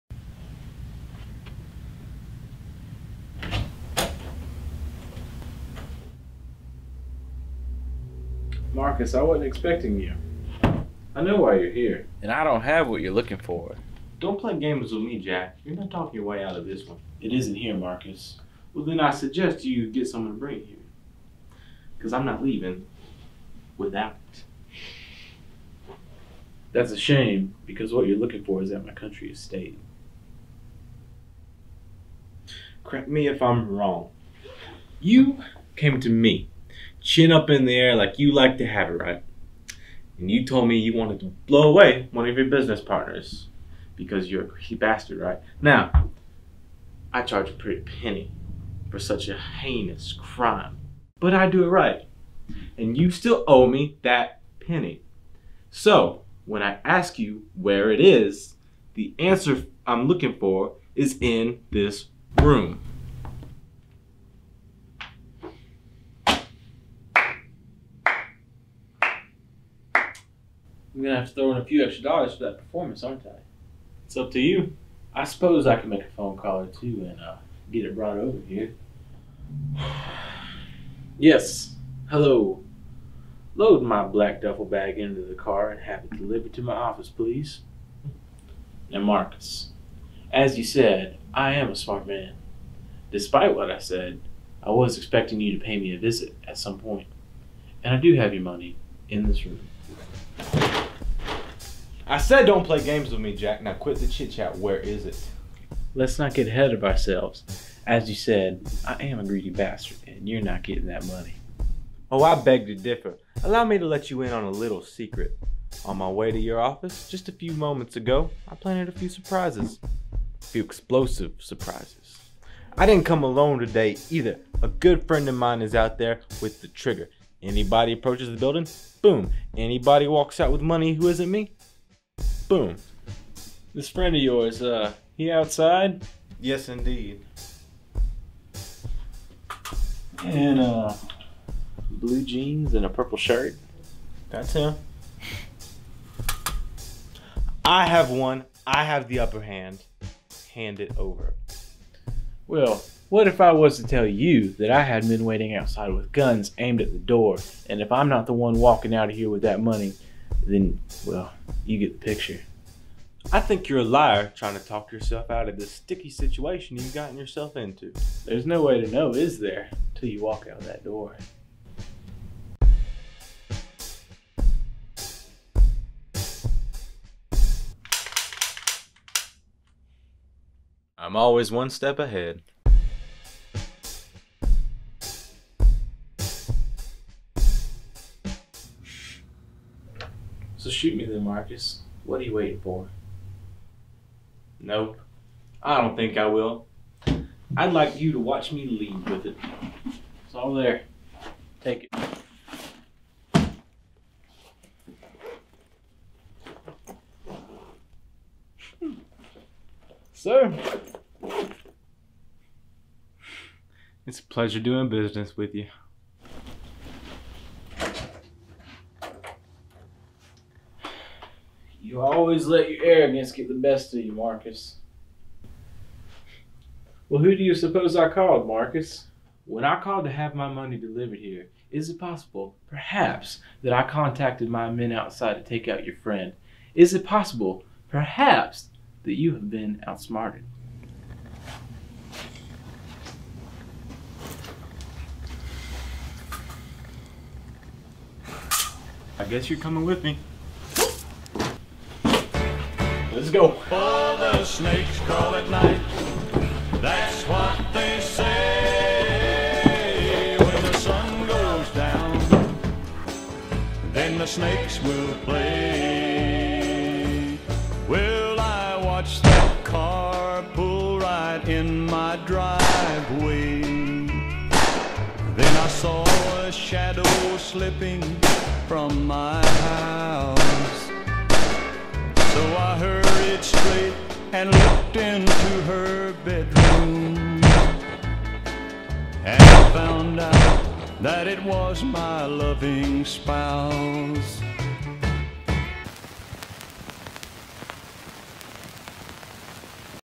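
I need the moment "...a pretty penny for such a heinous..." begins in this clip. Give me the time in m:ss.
0:47.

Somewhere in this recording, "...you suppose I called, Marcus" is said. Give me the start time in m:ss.
3:47.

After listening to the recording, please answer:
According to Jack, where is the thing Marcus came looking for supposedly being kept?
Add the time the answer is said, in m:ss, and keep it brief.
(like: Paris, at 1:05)
country estate, at 0:28.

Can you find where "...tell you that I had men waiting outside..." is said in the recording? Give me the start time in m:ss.
2:33.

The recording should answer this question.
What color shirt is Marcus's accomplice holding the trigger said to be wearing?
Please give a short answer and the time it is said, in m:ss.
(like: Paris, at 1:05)
purple, at 2:22.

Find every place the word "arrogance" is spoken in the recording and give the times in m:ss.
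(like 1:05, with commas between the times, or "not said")
3:42.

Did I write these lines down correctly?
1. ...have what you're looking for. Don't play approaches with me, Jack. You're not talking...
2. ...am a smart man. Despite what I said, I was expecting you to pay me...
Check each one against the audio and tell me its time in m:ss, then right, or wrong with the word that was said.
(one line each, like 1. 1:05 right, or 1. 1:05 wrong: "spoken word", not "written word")
1. 0:12 wrong: "games", not "approaches"
2. 1:31 right.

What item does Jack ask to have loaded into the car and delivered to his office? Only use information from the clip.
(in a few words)
black duffel bag.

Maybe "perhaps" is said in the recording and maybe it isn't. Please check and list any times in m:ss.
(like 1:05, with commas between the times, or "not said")
3:52, 3:57.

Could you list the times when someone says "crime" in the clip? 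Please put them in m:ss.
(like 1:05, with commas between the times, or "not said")
0:50.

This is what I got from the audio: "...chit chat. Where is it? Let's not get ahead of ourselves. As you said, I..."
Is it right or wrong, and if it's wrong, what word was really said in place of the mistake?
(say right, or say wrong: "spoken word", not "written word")
right.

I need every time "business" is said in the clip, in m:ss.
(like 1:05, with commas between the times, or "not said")
0:42, 3:34.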